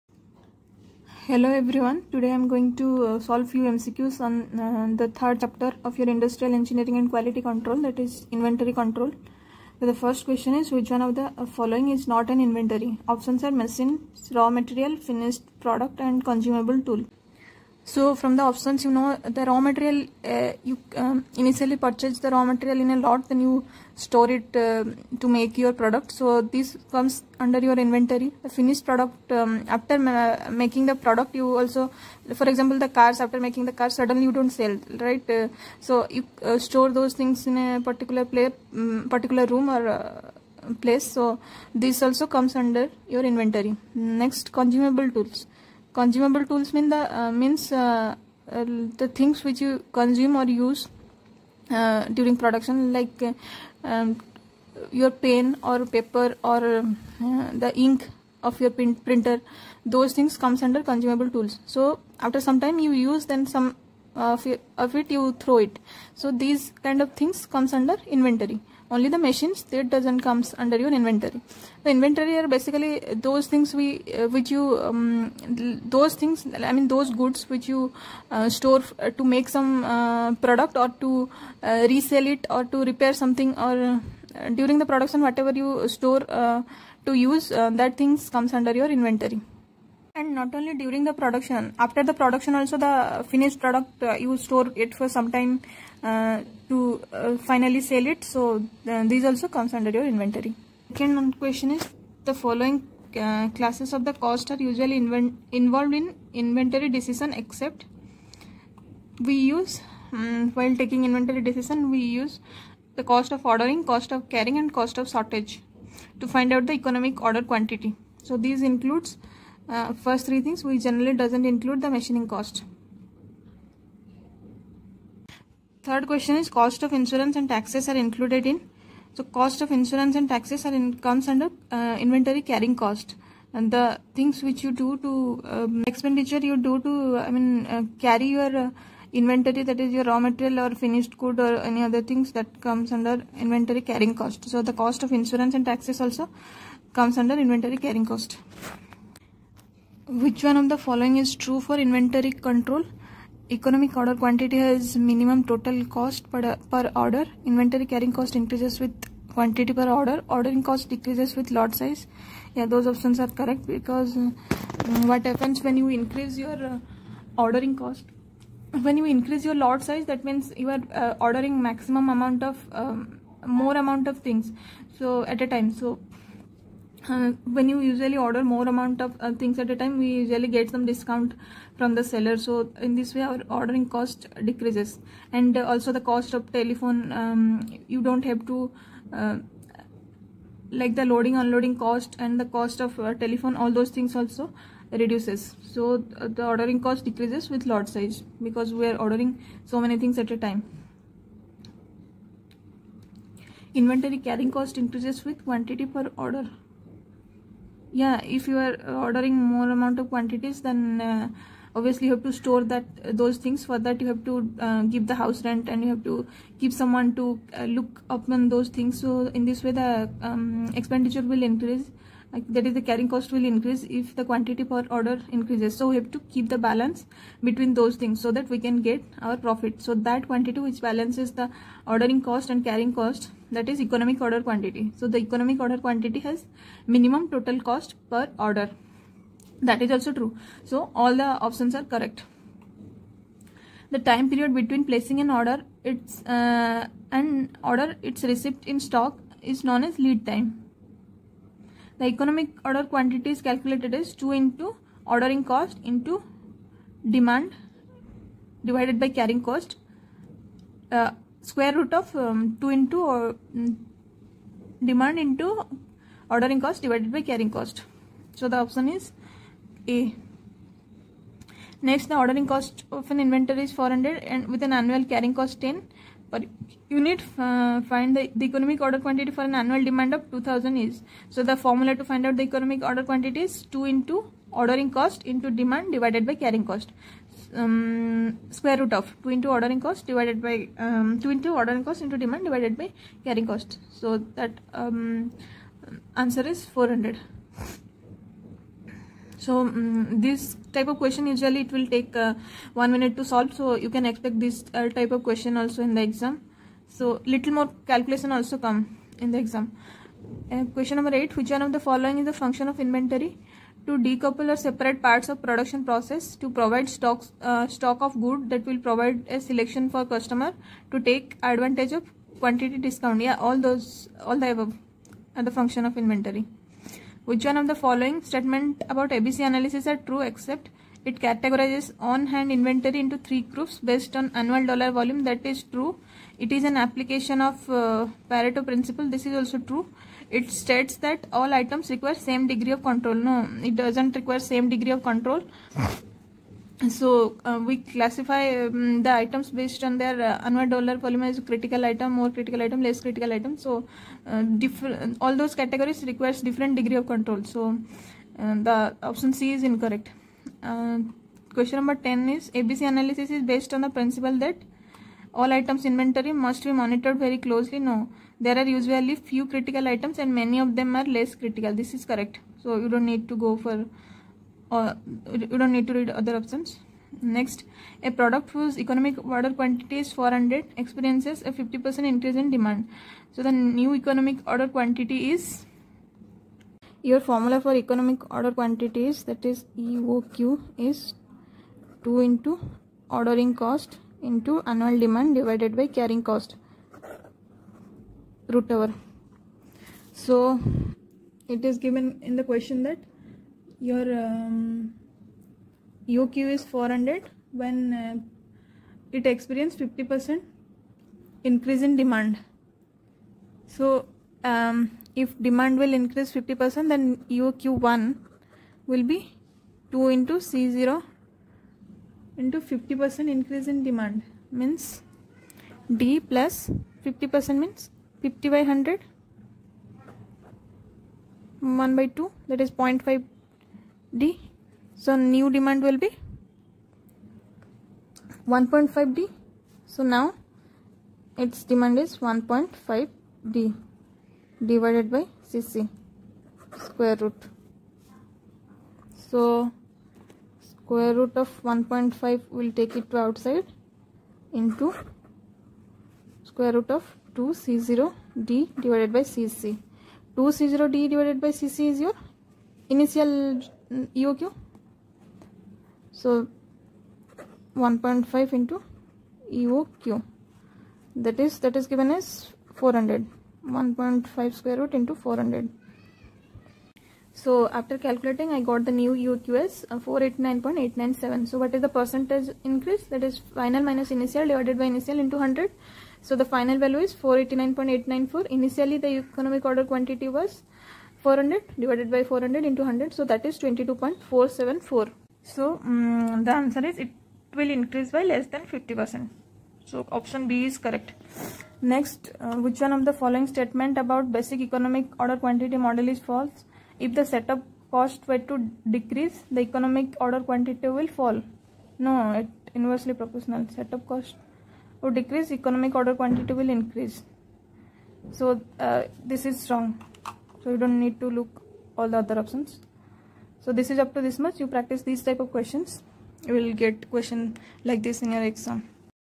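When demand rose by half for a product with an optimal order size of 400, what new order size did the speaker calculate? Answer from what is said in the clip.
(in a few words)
489.897.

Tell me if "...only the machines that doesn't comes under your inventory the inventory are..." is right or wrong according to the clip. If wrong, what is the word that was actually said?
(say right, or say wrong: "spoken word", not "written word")
right.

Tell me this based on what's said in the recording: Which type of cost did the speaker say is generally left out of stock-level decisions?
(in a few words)
Machining cost.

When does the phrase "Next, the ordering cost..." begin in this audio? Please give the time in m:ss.
4:31.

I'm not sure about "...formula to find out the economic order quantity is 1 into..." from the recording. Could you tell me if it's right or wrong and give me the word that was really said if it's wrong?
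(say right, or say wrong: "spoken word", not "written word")
wrong: "2", not "1".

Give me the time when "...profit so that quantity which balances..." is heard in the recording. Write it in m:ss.
3:49.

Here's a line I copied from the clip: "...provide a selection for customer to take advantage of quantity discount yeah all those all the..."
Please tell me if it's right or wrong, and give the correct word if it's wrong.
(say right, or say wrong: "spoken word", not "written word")
right.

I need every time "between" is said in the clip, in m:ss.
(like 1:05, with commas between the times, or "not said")
3:47, 4:04.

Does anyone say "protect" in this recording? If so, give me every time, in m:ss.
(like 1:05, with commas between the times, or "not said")
not said.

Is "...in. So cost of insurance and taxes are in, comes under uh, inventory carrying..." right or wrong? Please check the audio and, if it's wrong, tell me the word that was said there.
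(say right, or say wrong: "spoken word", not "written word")
right.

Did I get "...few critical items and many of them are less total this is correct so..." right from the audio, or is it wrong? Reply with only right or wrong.
wrong.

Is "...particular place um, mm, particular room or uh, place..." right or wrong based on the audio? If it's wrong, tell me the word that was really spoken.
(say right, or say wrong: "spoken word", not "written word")
right.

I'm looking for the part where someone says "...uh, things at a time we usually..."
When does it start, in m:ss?
2:59.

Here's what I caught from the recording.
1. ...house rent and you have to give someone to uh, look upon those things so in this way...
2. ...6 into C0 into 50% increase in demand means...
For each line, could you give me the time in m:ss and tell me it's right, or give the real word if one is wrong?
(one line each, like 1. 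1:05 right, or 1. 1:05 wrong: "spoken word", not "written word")
1. 3:35 right
2. 6:59 wrong: "2", not "6".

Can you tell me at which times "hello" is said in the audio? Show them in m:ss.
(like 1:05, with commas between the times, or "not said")
0:01.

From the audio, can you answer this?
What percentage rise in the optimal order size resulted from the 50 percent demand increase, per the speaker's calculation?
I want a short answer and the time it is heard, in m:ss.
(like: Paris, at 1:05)
22.474%, at 8:13.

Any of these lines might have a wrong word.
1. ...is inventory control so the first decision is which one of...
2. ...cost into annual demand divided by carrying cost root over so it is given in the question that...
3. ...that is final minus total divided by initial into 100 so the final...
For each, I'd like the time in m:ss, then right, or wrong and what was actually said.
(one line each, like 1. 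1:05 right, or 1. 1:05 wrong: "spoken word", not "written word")
1. 0:08 wrong: "question", not "decision"
2. 6:33 right
3. 8:03 wrong: "initial", not "total".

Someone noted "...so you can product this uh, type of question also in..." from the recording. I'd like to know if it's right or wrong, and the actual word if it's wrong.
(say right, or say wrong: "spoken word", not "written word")
wrong: "expect", not "product".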